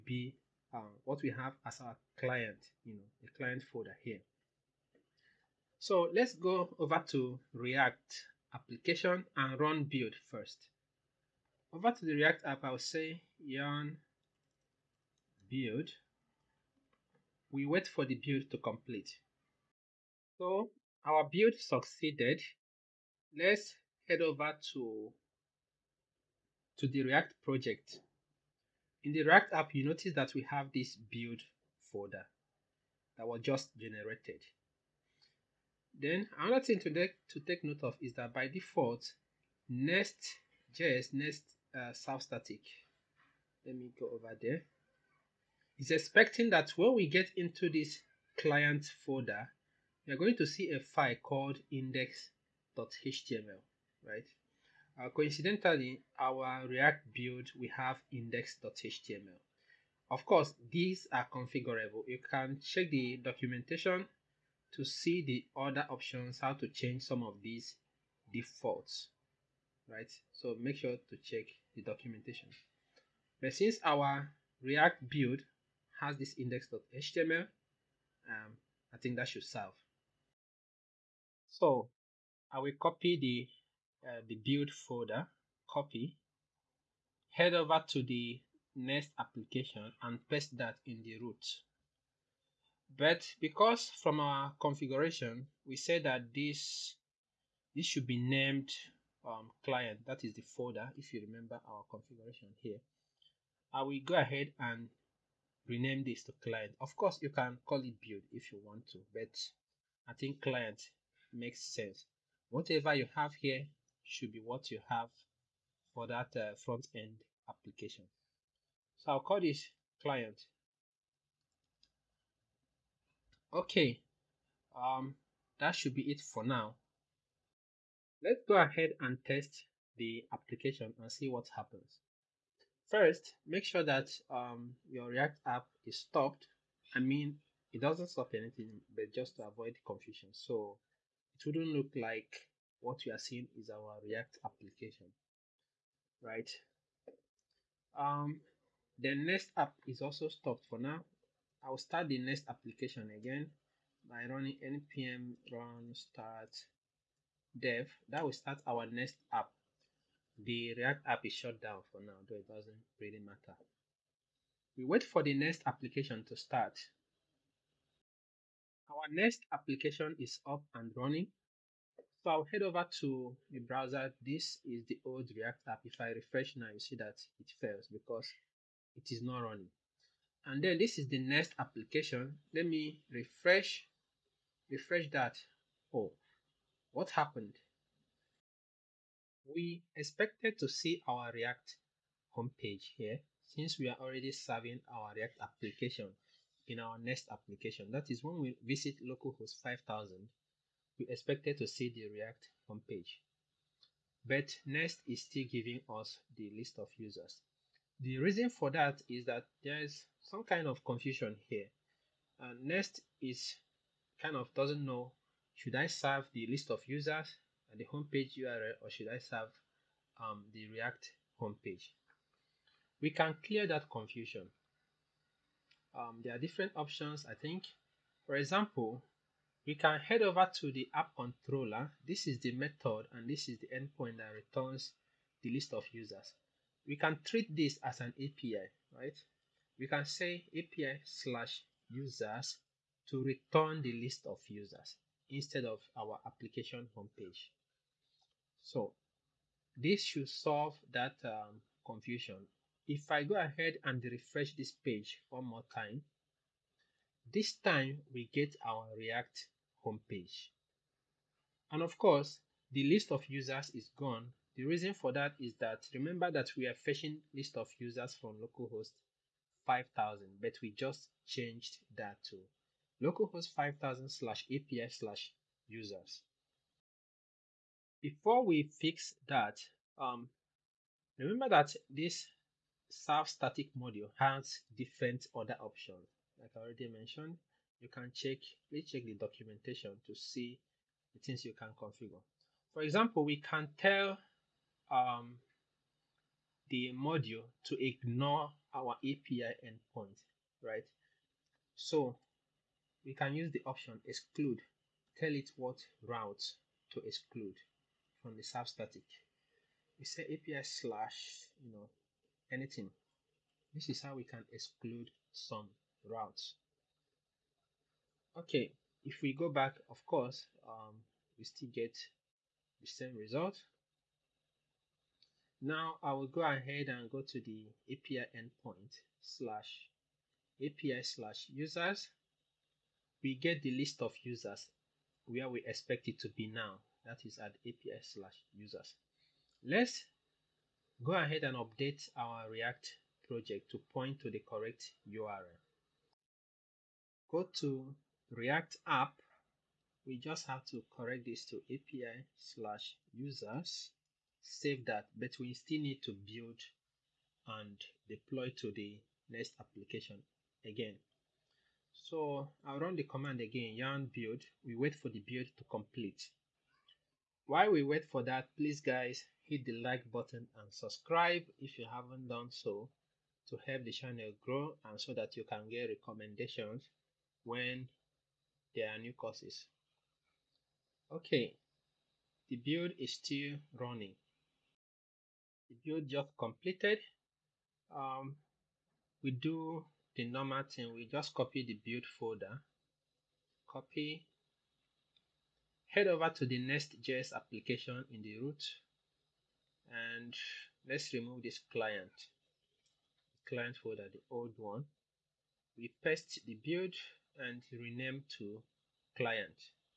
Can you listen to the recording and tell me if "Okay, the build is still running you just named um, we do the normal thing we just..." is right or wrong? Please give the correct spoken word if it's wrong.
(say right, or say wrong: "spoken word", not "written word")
wrong: "completed", not "named".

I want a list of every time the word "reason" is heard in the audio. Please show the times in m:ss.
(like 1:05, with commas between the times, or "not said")
3:28, 4:24.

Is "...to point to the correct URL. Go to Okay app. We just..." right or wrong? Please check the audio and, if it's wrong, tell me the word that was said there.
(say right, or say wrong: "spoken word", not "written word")
wrong: "React", not "Okay".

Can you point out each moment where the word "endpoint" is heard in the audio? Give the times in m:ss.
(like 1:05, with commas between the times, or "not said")
3:53, 4:59, 5:28.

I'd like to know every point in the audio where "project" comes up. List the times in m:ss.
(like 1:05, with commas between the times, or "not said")
0:27, 5:43.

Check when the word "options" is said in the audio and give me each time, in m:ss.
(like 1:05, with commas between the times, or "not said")
1:05, 3:46, 4:45, 5:03.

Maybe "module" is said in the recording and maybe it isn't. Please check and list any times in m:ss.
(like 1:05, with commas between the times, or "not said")
4:43, 4:56.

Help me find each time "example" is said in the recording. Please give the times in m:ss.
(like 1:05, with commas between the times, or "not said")
3:48, 4:52.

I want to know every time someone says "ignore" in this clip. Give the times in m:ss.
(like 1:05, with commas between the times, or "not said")
4:57.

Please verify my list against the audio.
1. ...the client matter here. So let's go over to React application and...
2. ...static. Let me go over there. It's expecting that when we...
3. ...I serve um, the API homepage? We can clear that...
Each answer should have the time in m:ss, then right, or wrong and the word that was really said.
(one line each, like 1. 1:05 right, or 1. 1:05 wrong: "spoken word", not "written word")
1. 0:03 wrong: "folder", not "matter"
2. 0:42 right
3. 3:39 wrong: "React", not "API".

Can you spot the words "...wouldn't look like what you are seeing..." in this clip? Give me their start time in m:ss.
2:21.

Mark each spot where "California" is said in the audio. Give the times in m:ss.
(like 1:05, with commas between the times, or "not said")
not said.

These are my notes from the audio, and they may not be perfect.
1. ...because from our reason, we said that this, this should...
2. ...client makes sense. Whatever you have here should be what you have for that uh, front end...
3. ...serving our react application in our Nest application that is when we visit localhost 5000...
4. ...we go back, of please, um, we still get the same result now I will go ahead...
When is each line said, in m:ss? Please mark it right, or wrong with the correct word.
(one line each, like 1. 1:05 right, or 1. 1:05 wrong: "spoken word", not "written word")
1. 1:33 wrong: "configuration", not "reason"
2. 1:50 right
3. 3:14 right
4. 5:19 wrong: "course", not "please".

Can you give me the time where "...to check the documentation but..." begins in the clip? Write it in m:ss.
1:11.